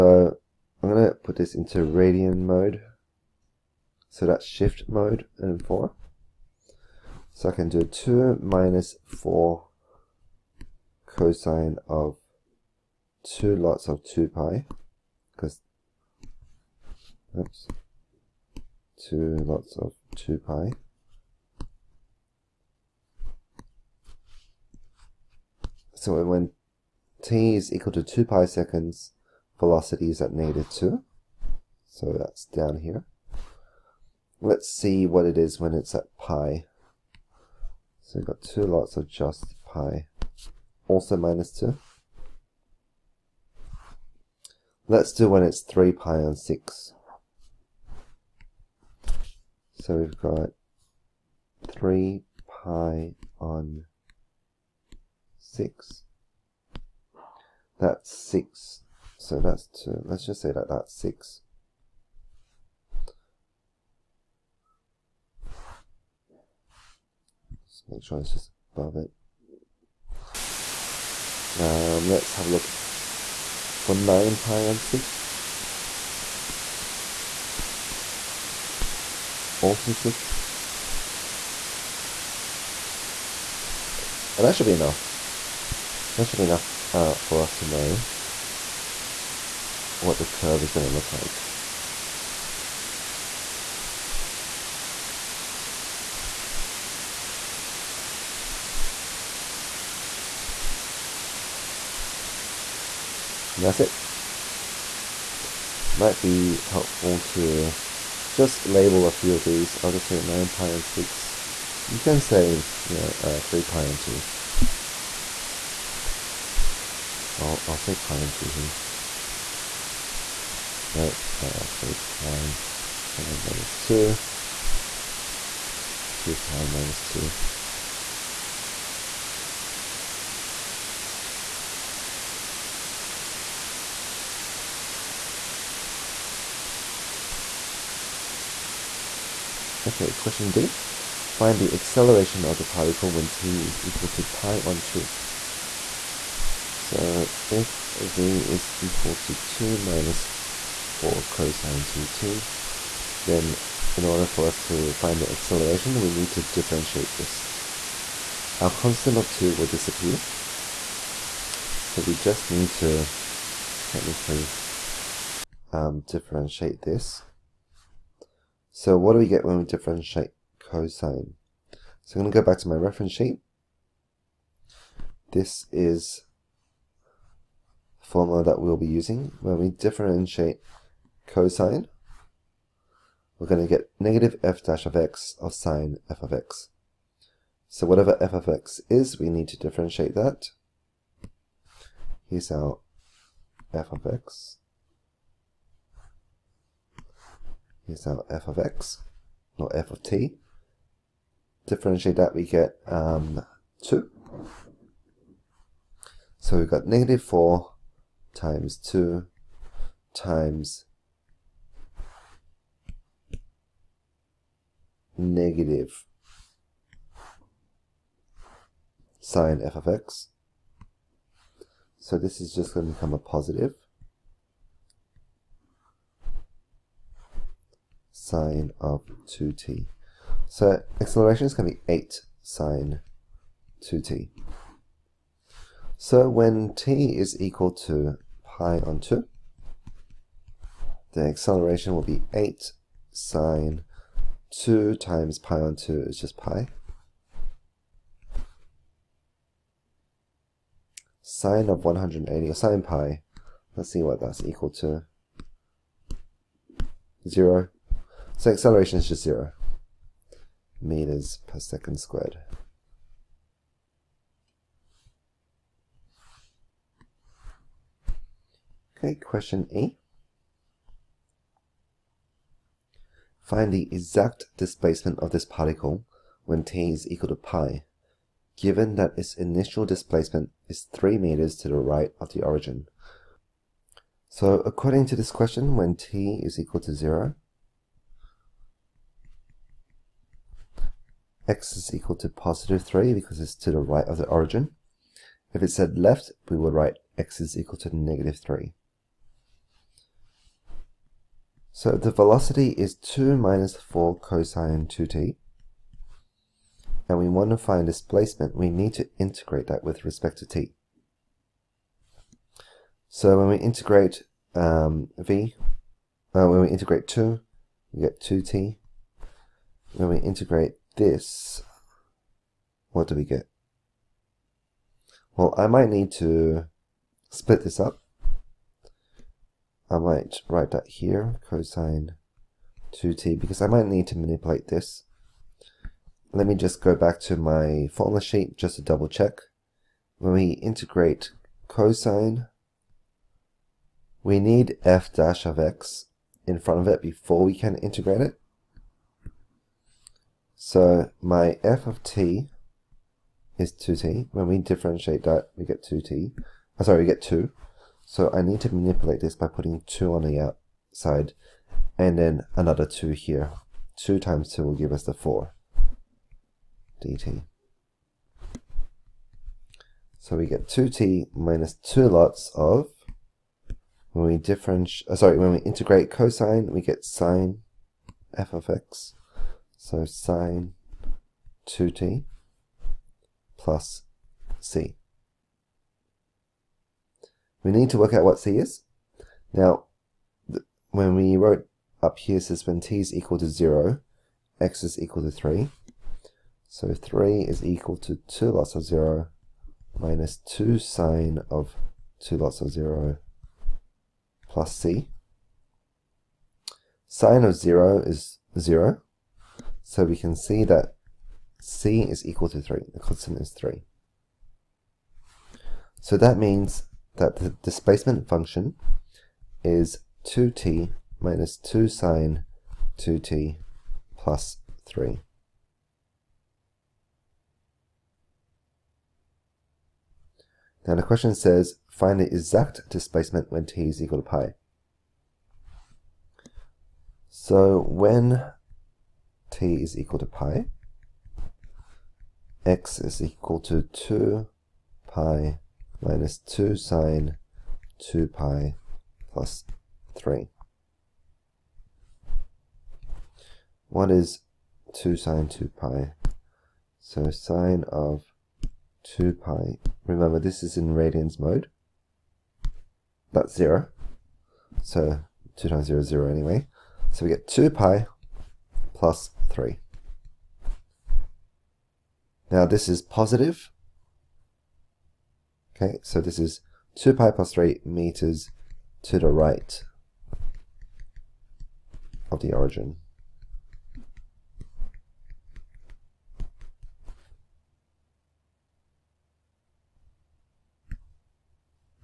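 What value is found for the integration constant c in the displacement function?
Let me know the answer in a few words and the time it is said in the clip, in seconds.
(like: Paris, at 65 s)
3, at 411 s.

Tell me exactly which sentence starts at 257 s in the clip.
0, so acceleration is just zero meters per second squared.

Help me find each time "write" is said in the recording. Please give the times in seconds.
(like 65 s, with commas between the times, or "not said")
296 s, 330 s.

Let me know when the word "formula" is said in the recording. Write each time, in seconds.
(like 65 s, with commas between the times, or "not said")
178 s, 337 s.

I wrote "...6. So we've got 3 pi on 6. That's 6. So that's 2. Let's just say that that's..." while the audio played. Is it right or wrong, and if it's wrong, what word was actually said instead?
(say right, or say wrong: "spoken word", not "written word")
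right.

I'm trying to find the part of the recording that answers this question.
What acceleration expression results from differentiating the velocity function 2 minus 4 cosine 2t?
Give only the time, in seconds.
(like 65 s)
231 s.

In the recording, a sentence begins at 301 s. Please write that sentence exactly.
So the velocity is 2 minus 4 cosine 2t.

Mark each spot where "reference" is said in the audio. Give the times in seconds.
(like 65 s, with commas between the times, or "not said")
172 s.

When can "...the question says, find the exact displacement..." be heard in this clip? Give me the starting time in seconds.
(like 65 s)
430 s.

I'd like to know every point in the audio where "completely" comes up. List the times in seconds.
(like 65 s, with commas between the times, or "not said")
not said.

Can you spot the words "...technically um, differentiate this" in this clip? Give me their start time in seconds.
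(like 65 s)
163 s.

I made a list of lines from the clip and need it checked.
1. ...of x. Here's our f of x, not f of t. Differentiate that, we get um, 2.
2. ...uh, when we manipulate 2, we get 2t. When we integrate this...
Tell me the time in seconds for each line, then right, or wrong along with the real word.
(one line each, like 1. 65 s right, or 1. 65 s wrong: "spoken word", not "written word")
1. 193 s right
2. 316 s wrong: "integrate", not "manipulate".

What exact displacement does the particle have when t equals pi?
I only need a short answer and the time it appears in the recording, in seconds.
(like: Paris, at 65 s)
2 pi plus 3 meters, at 476 s.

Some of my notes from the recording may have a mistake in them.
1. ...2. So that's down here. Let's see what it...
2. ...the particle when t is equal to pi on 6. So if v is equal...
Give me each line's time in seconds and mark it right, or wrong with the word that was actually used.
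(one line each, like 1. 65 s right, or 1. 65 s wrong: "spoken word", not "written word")
1. 30 s right
2. 142 s wrong: "2", not "6".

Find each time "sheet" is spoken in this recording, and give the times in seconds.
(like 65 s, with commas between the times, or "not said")
173 s, 338 s.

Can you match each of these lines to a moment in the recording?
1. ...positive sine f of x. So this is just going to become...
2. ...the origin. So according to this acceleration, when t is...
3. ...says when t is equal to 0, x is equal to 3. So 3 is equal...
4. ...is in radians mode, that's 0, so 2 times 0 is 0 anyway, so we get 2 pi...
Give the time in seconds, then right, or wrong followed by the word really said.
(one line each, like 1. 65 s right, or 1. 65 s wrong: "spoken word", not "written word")
1. 215 s wrong: "negative", not "positive"
2. 282 s wrong: "question", not "acceleration"
3. 392 s right
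4. 460 s right.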